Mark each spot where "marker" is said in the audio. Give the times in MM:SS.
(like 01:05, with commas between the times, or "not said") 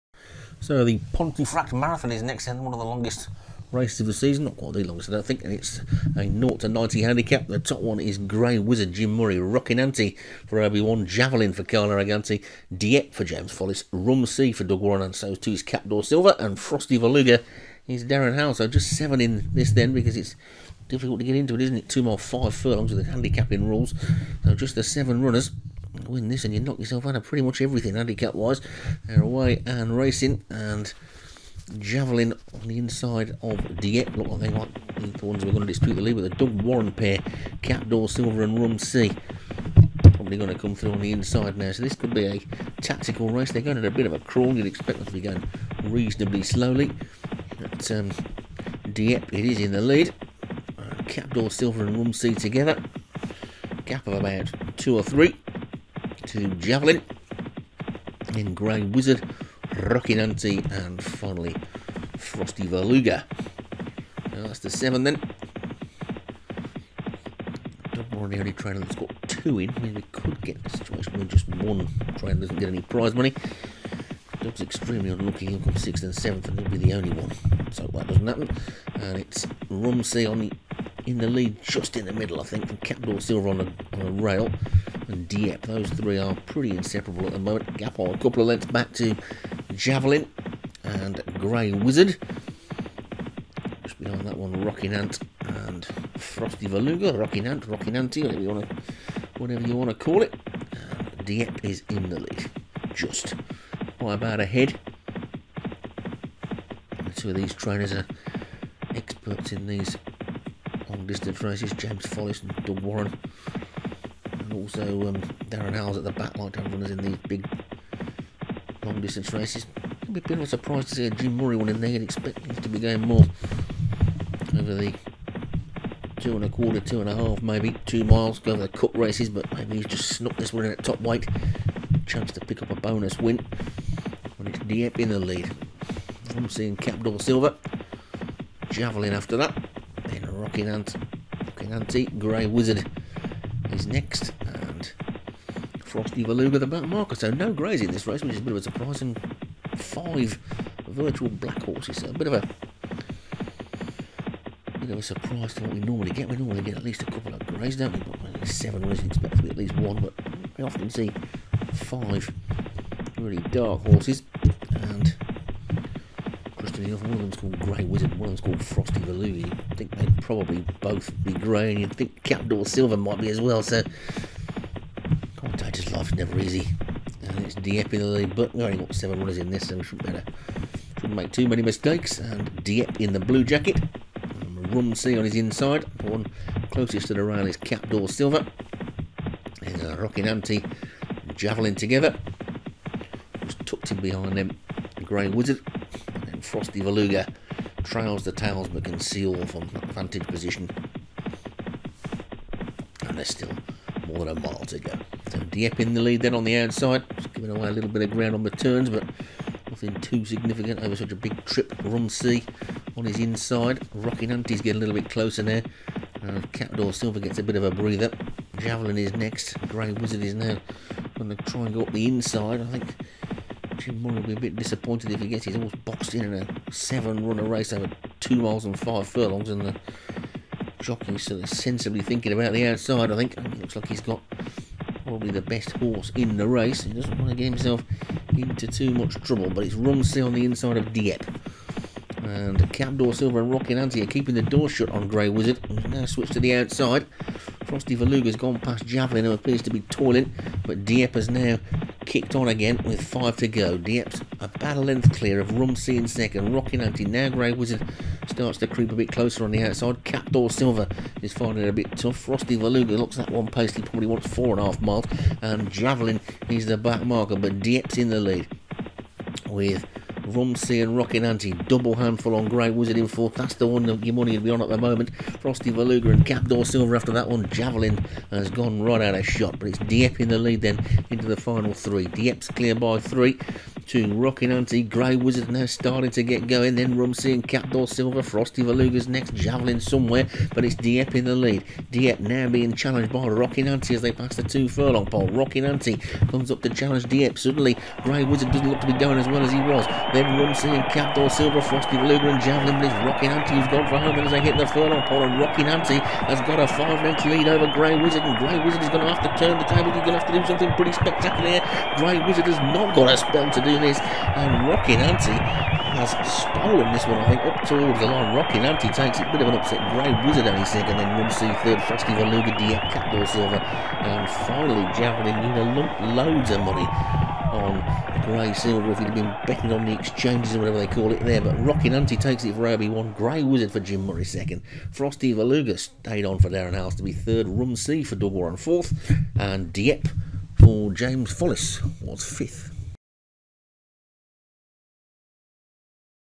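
02:26, 04:27.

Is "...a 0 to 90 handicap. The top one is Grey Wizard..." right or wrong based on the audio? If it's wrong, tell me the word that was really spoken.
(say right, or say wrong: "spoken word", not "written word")
right.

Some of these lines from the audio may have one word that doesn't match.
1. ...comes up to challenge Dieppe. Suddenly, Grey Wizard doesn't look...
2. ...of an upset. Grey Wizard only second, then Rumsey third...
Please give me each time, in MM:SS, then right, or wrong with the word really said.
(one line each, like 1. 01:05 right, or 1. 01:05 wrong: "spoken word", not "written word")
1. 04:56 right
2. 05:19 right.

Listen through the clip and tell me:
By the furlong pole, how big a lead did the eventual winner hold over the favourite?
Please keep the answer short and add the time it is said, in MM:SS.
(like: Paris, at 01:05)
5 lengths, at 05:06.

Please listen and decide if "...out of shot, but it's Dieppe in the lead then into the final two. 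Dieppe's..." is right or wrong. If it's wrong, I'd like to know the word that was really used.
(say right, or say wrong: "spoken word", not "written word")
wrong: "three", not "two".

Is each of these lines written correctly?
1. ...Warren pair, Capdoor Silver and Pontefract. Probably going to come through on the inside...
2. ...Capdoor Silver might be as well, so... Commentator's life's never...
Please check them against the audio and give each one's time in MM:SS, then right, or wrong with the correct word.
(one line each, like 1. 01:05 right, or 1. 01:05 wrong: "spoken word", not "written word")
1. 00:36 wrong: "Rumsey", not "Pontefract"
2. 02:52 right.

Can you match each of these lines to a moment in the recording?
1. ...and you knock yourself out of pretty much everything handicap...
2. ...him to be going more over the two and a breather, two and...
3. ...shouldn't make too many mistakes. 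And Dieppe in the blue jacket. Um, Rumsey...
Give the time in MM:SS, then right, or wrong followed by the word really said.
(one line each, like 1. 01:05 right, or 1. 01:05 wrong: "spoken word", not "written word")
1. 00:26 right
2. 02:02 wrong: "quarter", not "breather"
3. 03:00 right.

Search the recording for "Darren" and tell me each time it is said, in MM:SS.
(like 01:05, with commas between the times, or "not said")
00:18, 01:55, 05:36.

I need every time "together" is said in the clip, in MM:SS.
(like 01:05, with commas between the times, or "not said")
00:52, 03:11.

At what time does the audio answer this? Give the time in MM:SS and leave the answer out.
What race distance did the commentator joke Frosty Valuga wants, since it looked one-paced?
04:24.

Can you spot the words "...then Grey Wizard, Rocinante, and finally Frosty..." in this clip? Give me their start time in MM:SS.
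00:58.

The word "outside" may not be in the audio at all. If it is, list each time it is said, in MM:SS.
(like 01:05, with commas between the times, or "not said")
03:26, 03:52, 04:06, 04:19.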